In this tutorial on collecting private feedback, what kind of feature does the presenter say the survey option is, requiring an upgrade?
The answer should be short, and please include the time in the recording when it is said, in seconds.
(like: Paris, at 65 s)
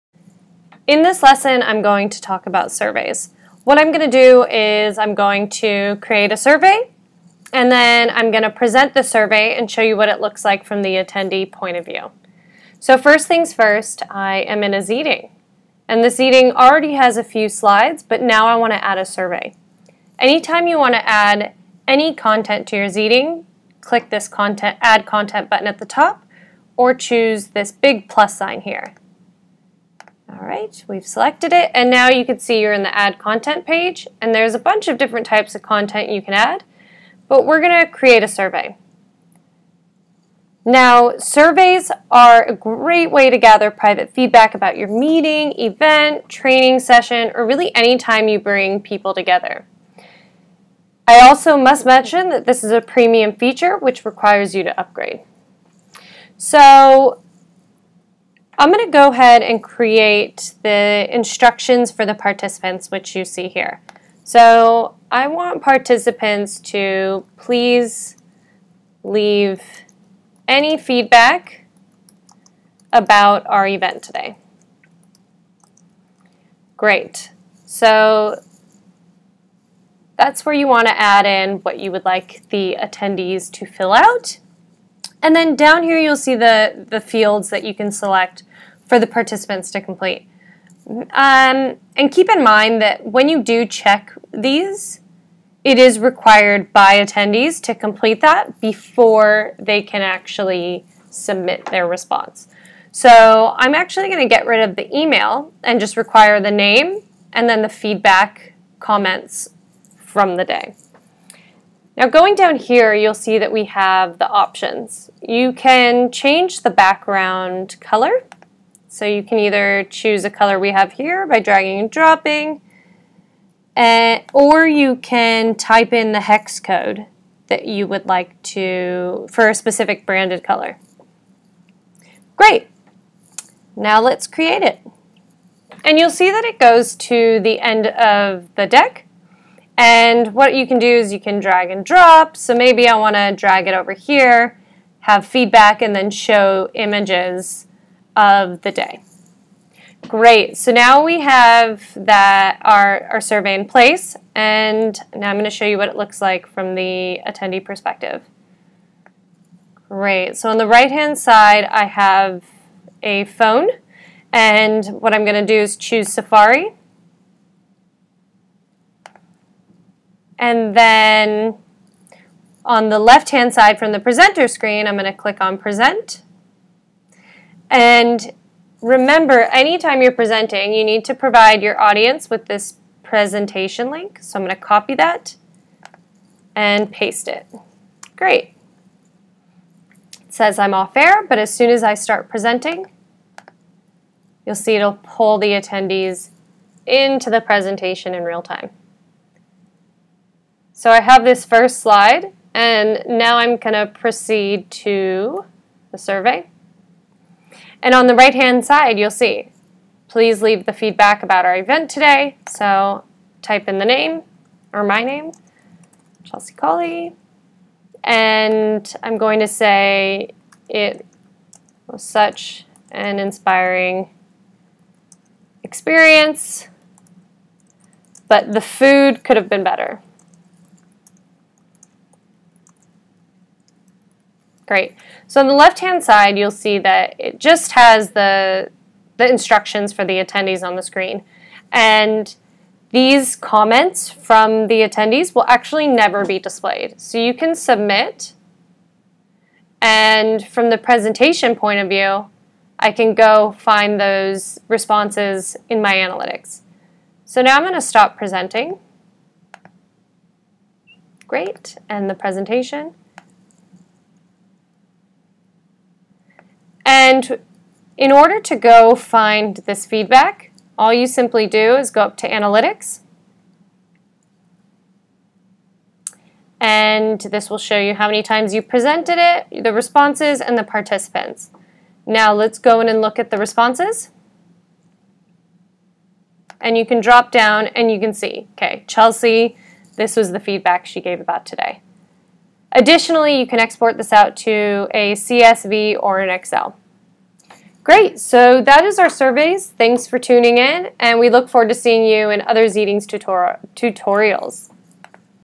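premium feature, at 52 s.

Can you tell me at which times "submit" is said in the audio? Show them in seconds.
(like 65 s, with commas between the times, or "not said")
101 s, 247 s.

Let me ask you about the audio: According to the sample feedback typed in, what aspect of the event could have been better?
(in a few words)
the food.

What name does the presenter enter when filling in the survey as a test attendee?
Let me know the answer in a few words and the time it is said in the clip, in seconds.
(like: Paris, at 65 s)
Chelsea Colley, at 216 s.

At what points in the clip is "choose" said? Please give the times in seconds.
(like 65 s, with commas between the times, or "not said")
26 s, 119 s, 165 s.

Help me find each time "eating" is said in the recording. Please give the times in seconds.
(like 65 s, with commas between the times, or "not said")
not said.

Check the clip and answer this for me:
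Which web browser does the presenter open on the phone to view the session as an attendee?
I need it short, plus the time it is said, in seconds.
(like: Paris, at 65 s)
Safari, at 166 s.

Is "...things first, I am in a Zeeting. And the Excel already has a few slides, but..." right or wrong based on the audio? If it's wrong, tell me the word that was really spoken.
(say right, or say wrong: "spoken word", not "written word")
wrong: "Zeeting", not "Excel".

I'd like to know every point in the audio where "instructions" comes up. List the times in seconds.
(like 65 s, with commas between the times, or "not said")
61 s, 239 s.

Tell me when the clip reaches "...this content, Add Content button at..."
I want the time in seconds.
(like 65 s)
24 s.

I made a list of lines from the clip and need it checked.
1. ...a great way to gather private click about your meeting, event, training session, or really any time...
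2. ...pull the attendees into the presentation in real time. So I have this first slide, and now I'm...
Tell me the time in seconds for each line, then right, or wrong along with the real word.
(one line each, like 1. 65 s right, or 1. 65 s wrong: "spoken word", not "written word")
1. 42 s wrong: "feedback", not "click"
2. 195 s right.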